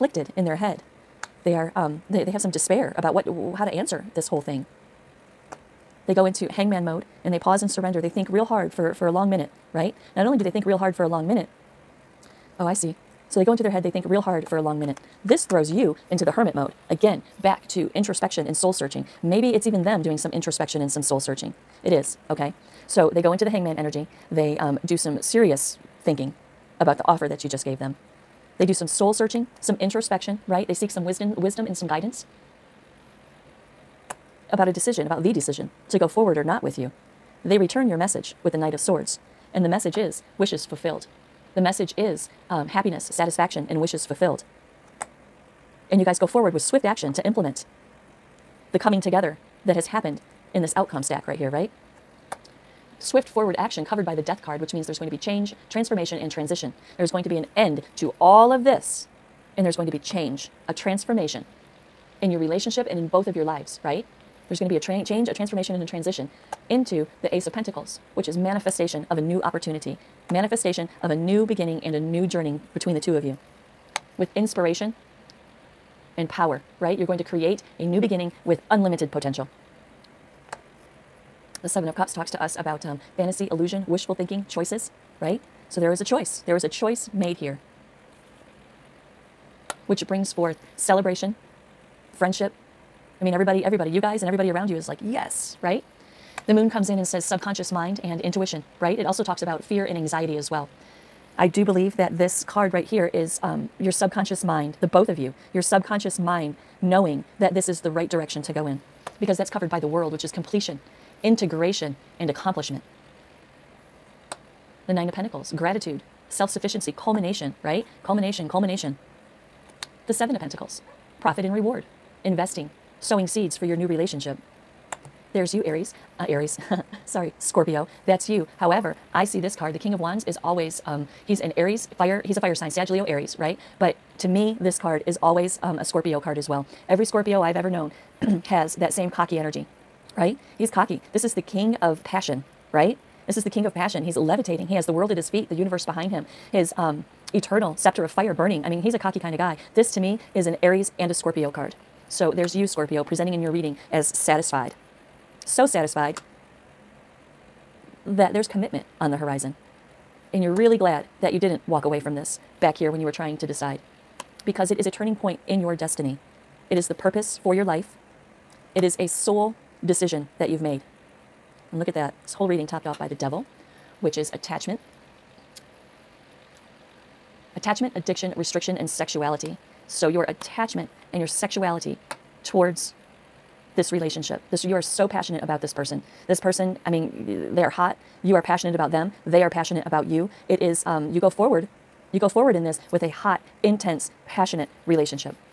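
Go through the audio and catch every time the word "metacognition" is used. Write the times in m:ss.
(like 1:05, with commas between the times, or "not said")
not said.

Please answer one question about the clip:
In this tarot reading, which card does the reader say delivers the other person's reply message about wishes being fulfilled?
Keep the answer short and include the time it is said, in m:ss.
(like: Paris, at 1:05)
Knight of Swords, at 0:38.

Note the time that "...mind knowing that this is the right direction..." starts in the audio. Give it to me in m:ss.
1:46.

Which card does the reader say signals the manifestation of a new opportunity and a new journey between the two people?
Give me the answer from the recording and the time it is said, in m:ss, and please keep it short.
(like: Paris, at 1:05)
Ace of Pentacles, at 1:07.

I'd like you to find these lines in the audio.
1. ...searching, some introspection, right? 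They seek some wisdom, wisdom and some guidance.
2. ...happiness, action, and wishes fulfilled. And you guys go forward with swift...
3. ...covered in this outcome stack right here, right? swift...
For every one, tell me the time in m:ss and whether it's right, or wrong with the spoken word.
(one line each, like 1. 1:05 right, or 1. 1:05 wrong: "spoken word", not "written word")
1. 0:29 right
2. 0:42 wrong: "satisfaction", not "action"
3. 0:49 wrong: "happened", not "covered".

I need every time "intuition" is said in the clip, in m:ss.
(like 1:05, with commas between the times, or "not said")
1:38.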